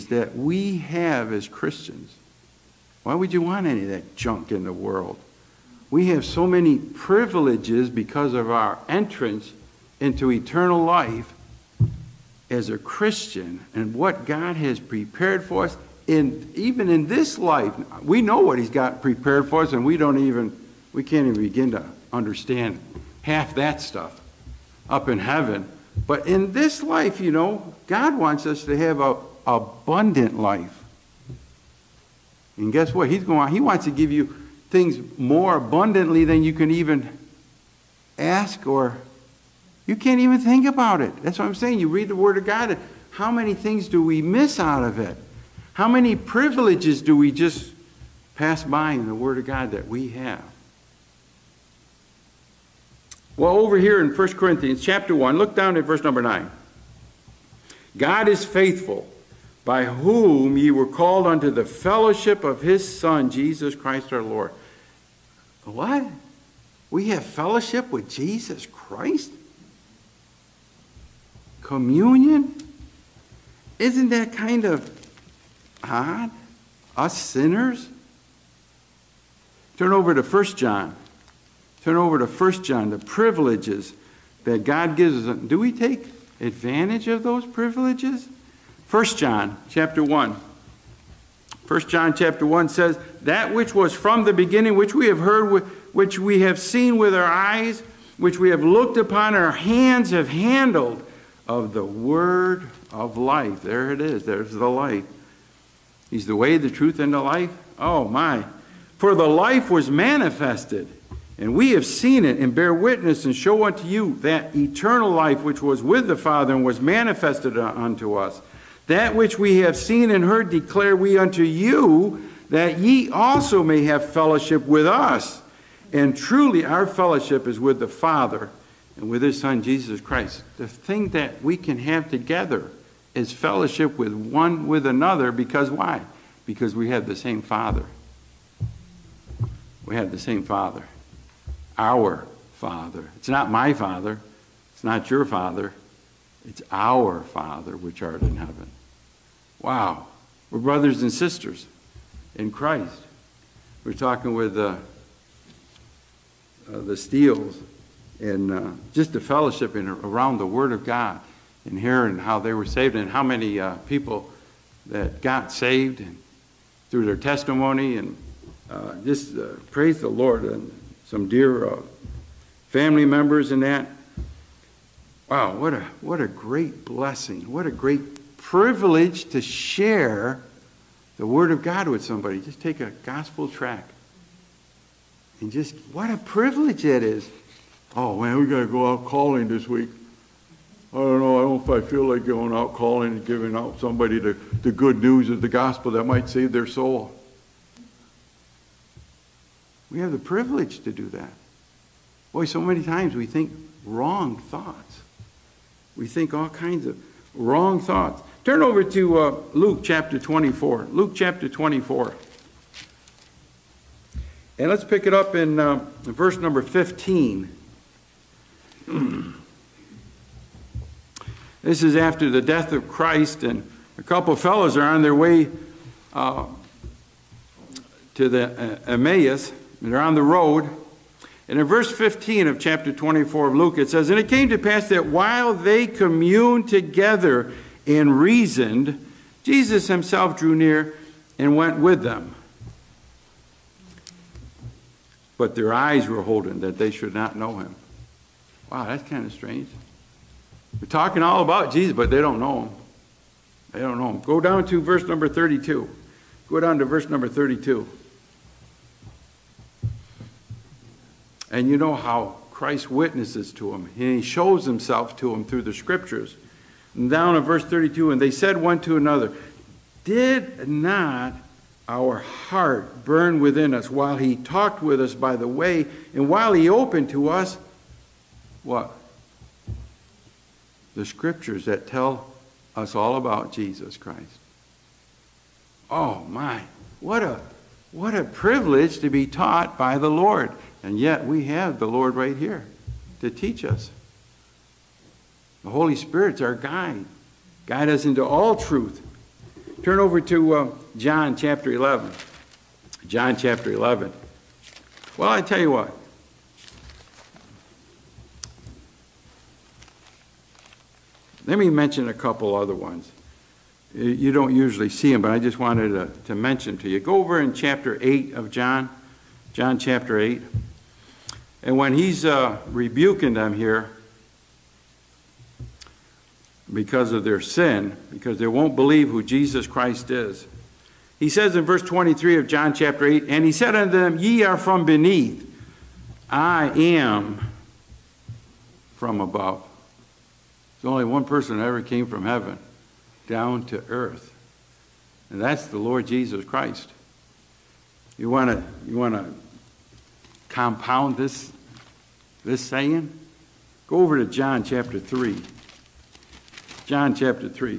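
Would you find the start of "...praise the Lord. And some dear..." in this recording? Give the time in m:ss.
2:49.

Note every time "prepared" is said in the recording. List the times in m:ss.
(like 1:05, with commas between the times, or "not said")
0:14, 0:19.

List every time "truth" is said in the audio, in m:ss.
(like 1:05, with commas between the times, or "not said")
1:46, 4:58.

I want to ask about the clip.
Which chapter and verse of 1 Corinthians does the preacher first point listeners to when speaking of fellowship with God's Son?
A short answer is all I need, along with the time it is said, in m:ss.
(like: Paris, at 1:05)
Chapter 1, verse 9, at 0:54.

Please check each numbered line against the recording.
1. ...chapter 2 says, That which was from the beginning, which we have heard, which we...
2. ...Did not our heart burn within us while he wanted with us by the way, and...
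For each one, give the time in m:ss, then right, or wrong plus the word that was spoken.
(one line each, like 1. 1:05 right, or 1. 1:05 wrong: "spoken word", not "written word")
1. 1:32 wrong: "1", not "2"
2. 4:30 wrong: "talked", not "wanted".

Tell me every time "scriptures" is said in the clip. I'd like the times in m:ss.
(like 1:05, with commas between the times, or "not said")
4:25, 4:41.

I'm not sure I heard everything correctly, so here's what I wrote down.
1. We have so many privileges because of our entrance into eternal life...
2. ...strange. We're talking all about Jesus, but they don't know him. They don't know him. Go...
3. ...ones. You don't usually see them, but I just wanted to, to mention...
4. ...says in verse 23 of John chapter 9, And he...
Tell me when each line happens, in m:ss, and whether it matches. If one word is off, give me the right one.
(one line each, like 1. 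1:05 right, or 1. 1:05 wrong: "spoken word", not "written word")
1. 0:05 right
2. 4:09 right
3. 5:12 right
4. 5:31 wrong: "8", not "9".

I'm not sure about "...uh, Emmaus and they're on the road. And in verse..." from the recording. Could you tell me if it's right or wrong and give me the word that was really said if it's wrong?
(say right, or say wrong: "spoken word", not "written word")
right.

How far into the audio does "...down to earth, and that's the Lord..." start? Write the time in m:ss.
5:43.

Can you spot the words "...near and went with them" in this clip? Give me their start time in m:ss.
4:00.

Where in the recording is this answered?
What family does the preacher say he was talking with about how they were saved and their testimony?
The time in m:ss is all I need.
2:36.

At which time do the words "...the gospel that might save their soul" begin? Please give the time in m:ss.
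3:15.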